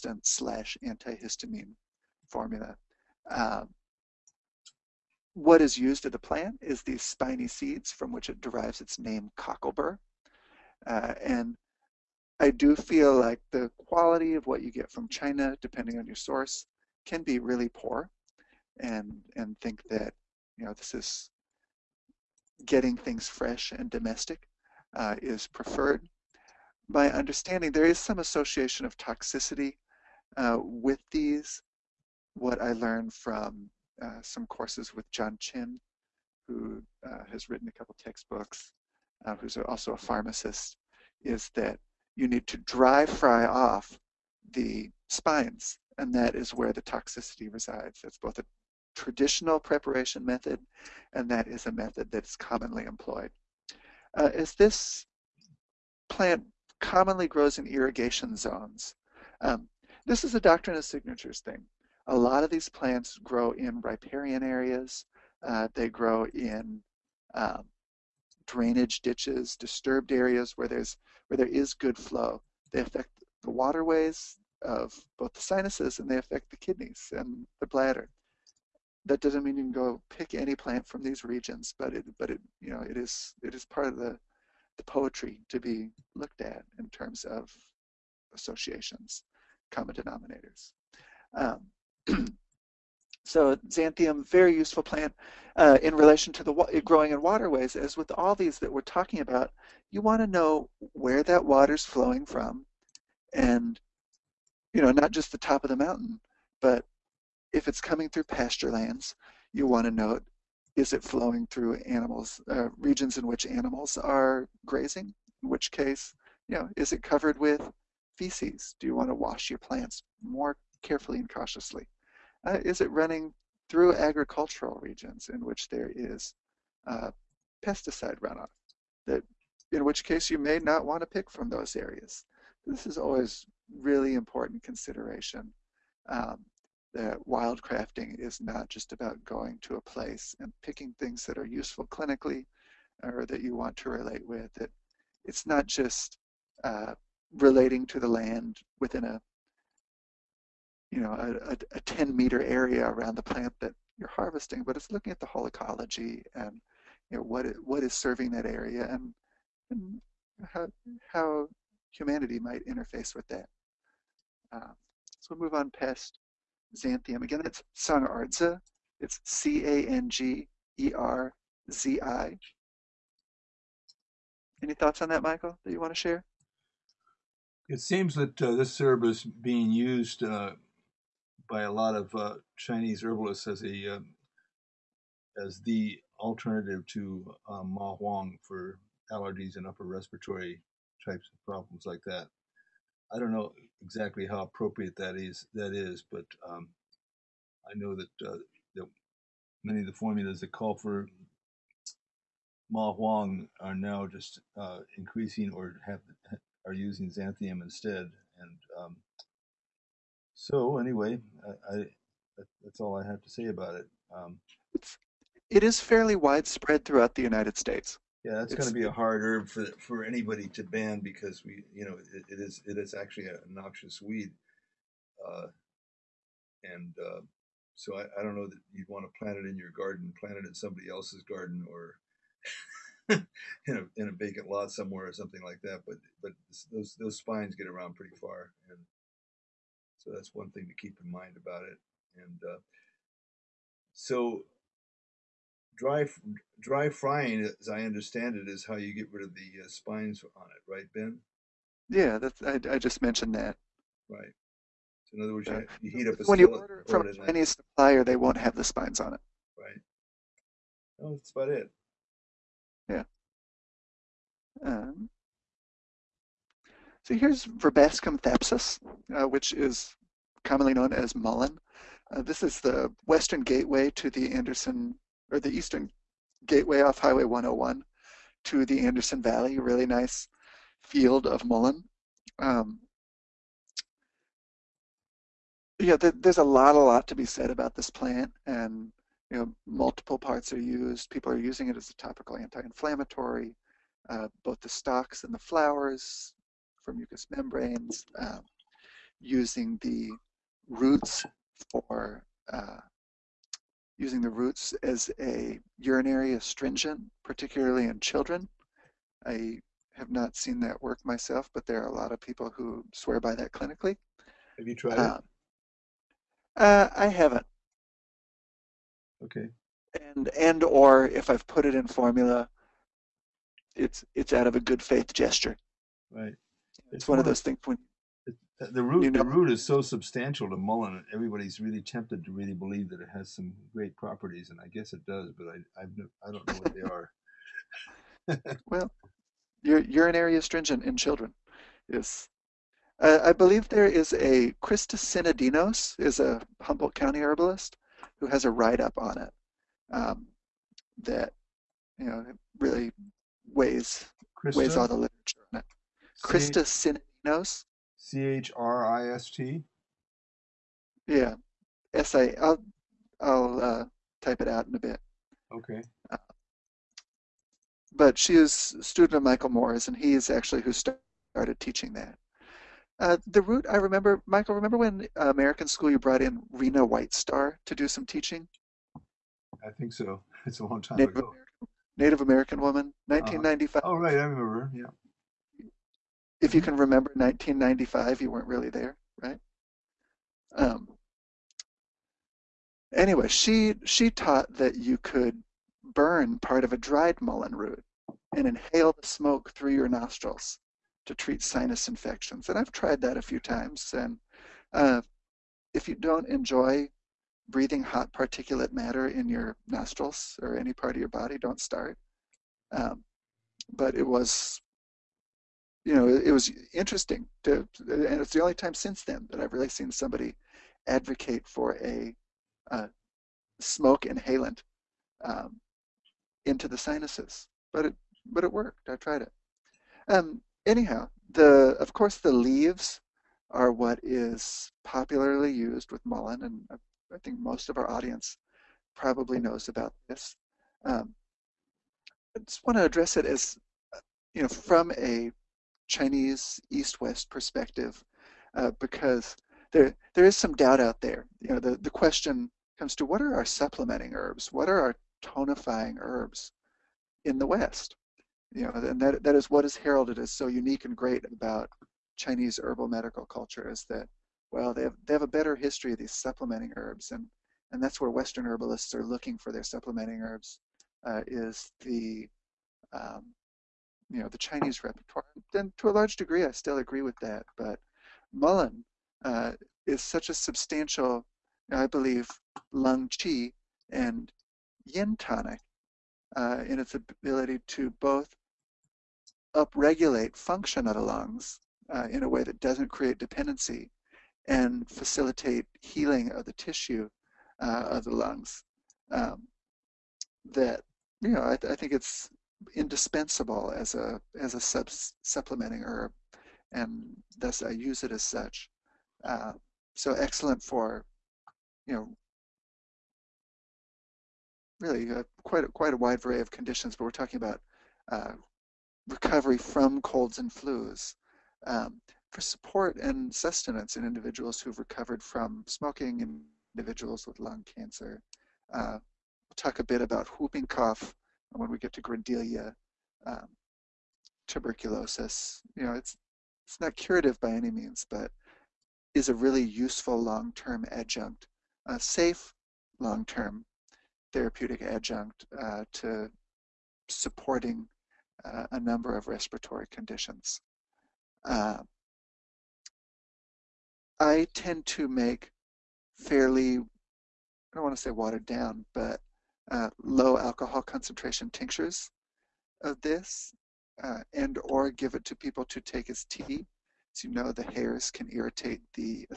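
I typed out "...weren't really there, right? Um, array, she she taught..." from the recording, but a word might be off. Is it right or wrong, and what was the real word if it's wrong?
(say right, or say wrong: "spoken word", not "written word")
wrong: "anyway", not "array".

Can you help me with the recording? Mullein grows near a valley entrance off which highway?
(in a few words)
Highway 101.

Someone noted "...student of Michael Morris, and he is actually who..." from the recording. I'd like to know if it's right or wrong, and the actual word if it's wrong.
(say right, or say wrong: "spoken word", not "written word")
right.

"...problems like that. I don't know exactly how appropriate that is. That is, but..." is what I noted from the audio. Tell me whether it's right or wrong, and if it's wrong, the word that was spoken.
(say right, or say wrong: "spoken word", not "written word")
right.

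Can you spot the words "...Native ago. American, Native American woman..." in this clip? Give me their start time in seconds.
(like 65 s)
380 s.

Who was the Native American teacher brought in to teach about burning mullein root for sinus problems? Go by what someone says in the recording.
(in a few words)
Rena White Star.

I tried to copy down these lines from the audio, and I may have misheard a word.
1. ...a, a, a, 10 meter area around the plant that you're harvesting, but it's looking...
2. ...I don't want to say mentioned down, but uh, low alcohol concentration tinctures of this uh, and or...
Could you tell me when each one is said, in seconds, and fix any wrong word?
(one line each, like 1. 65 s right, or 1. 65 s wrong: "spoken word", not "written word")
1. 151 s right
2. 556 s wrong: "watered", not "mentioned".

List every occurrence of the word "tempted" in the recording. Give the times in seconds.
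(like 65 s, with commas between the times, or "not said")
331 s.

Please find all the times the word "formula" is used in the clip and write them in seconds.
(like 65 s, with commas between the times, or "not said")
2 s, 199 s, 321 s.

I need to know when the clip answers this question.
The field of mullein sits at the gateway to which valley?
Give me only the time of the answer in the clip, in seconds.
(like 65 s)
278 s.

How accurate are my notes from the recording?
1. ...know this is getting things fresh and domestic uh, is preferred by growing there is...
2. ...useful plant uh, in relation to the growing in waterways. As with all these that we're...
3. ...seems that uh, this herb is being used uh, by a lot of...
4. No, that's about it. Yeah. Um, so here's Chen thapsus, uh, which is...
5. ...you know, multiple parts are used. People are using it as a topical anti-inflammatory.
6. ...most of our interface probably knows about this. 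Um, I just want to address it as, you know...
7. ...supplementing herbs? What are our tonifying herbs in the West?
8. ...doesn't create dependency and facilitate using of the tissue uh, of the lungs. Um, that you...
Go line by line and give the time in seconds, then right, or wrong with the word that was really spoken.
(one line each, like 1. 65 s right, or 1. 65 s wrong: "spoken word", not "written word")
1. 20 s wrong: "understanding", not "growing"
2. 94 s right
3. 177 s right
4. 261 s wrong: "Verbascum", not "Chen"
5. 289 s right
6. 437 s wrong: "audience", not "interface"
7. 453 s right
8. 492 s wrong: "healing", not "using".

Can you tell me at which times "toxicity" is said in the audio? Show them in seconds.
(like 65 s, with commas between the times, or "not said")
28 s, 46 s.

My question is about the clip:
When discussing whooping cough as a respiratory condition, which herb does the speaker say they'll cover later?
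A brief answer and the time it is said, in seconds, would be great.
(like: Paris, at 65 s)
Grindelia, at 532 s.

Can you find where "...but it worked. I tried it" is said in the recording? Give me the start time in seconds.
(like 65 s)
428 s.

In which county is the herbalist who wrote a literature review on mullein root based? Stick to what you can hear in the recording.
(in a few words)
Humboldt County.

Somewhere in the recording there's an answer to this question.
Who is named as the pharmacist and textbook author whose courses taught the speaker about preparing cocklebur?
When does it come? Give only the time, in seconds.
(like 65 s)
35 s.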